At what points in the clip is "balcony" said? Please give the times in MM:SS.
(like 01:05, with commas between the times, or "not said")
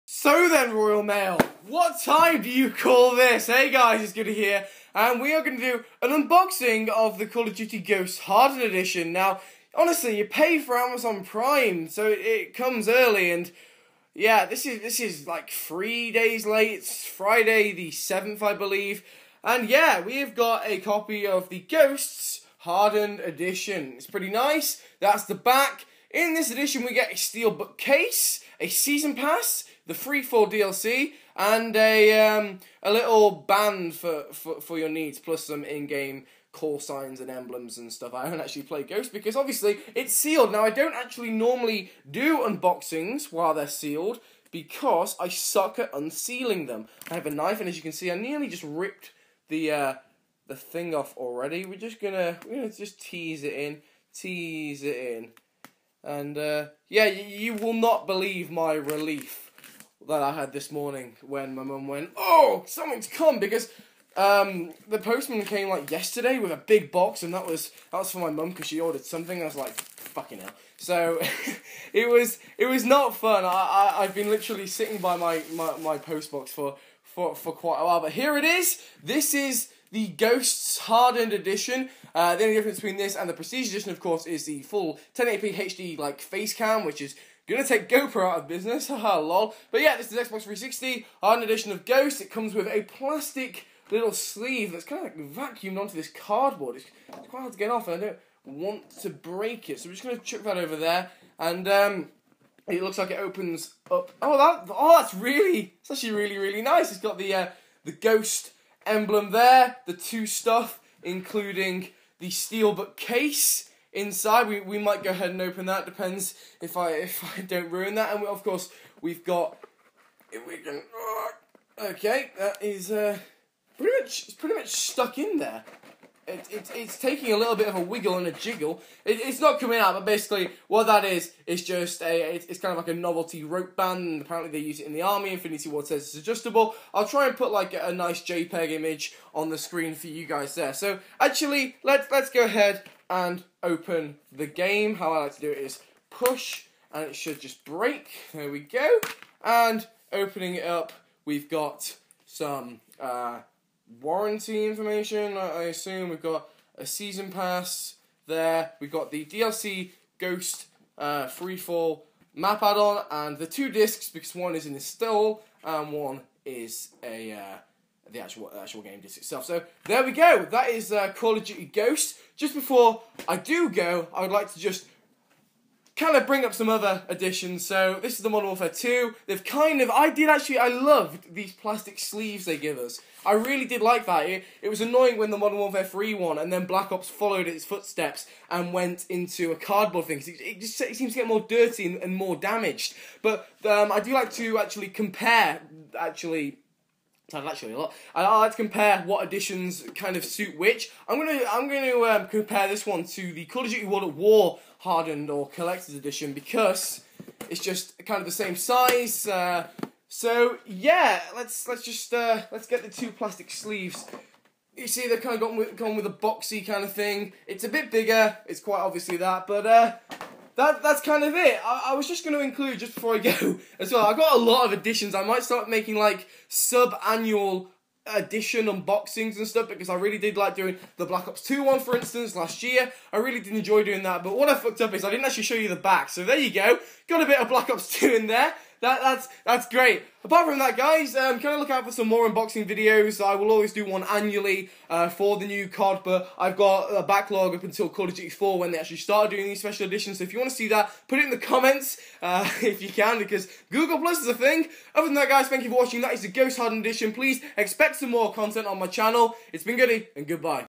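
not said.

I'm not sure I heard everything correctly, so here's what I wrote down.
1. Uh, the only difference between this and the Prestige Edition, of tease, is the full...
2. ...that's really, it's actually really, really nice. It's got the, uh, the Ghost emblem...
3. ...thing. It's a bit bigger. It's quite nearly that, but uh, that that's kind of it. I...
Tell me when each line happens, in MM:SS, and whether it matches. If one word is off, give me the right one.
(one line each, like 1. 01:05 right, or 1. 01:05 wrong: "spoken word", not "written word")
1. 01:22 wrong: "course", not "tease"
2. 01:45 right
3. 03:36 wrong: "obviously", not "nearly".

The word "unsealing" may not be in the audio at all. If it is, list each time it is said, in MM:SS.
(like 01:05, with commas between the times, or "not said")
00:45.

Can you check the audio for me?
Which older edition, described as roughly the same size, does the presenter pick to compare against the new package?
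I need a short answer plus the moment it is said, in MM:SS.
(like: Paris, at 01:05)
Call of Duty World at War, at 03:23.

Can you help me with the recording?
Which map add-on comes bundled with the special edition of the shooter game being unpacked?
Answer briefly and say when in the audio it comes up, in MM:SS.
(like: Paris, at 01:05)
Free Fall, at 00:29.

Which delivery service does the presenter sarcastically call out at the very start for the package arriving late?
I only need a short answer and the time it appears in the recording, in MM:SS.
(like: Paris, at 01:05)
Royal Mail, at 00:00.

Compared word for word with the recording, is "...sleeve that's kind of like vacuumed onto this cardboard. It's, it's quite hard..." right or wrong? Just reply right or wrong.
right.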